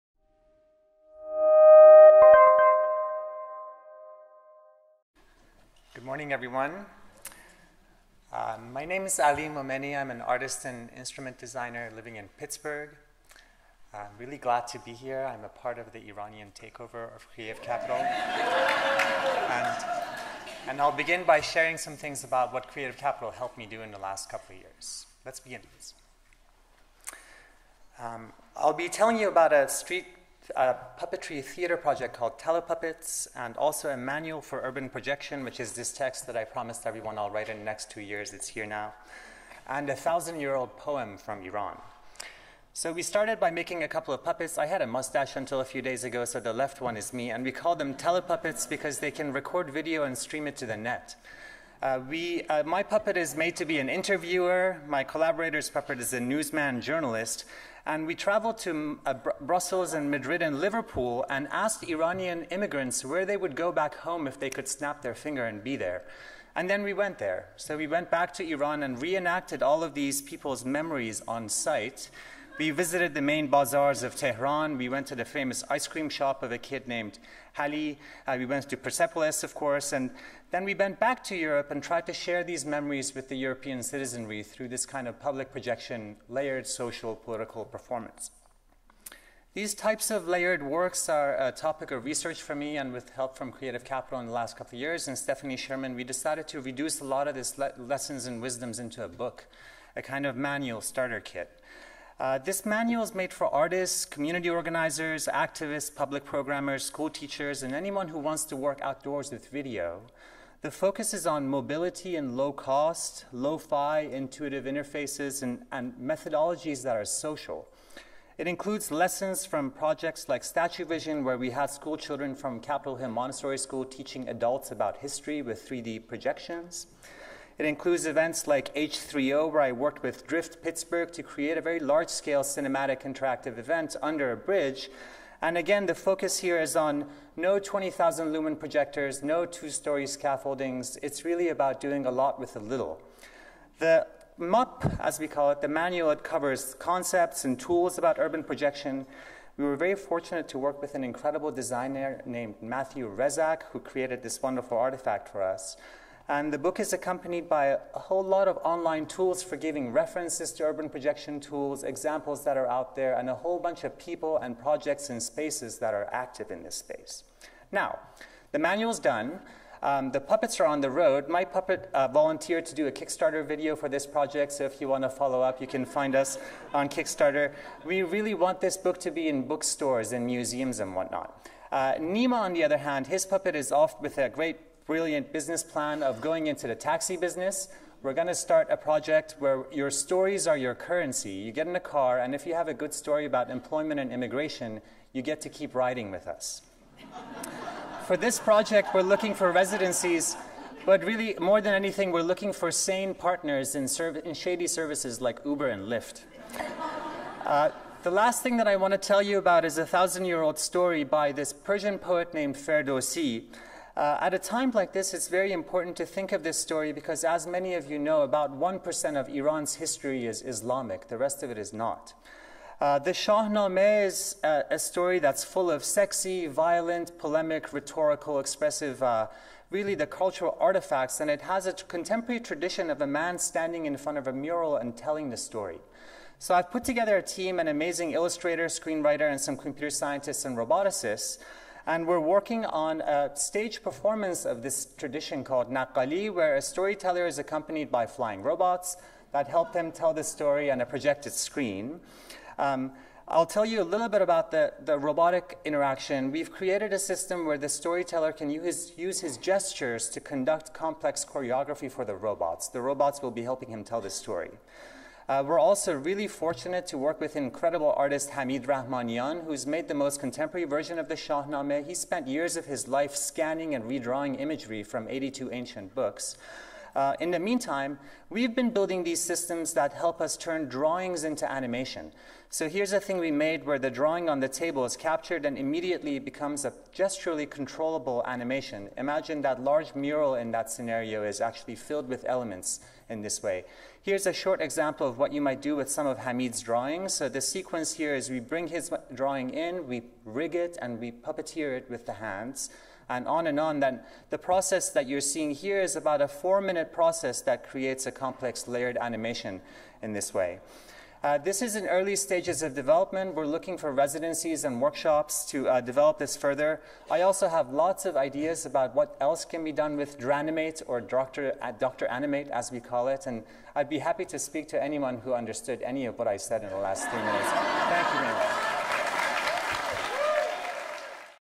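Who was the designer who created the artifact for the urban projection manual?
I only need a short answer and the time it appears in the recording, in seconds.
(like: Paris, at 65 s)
Matthew Rezak, at 152 s.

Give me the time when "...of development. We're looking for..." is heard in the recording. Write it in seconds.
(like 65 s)
312 s.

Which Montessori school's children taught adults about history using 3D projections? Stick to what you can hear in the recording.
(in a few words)
Capitol Hill Montessori School.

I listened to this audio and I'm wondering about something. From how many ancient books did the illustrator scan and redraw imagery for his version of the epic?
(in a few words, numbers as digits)
82.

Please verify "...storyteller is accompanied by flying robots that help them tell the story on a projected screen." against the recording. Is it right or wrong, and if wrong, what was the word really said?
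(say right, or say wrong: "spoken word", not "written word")
right.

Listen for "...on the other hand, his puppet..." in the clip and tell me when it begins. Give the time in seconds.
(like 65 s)
182 s.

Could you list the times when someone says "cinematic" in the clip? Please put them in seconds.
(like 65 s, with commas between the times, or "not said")
132 s.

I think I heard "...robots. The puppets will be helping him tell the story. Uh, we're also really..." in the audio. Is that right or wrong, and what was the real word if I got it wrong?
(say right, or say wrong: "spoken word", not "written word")
wrong: "robots", not "puppets".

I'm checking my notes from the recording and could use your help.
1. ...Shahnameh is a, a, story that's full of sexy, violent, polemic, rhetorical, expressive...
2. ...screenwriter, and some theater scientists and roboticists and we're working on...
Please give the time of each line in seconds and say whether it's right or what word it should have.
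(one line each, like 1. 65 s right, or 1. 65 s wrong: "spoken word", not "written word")
1. 223 s right
2. 238 s wrong: "computer", not "theater".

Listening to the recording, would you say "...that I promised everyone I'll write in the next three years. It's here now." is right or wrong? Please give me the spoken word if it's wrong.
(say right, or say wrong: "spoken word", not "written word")
wrong: "two", not "three".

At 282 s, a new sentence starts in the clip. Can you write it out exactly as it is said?
So here's a thing we made where the drawing on the table is captured and immediately becomes a gesturally controllable animation.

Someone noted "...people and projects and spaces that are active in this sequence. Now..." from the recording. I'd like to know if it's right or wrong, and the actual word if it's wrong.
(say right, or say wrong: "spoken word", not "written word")
wrong: "space", not "sequence".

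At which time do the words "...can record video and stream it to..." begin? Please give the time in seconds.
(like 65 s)
49 s.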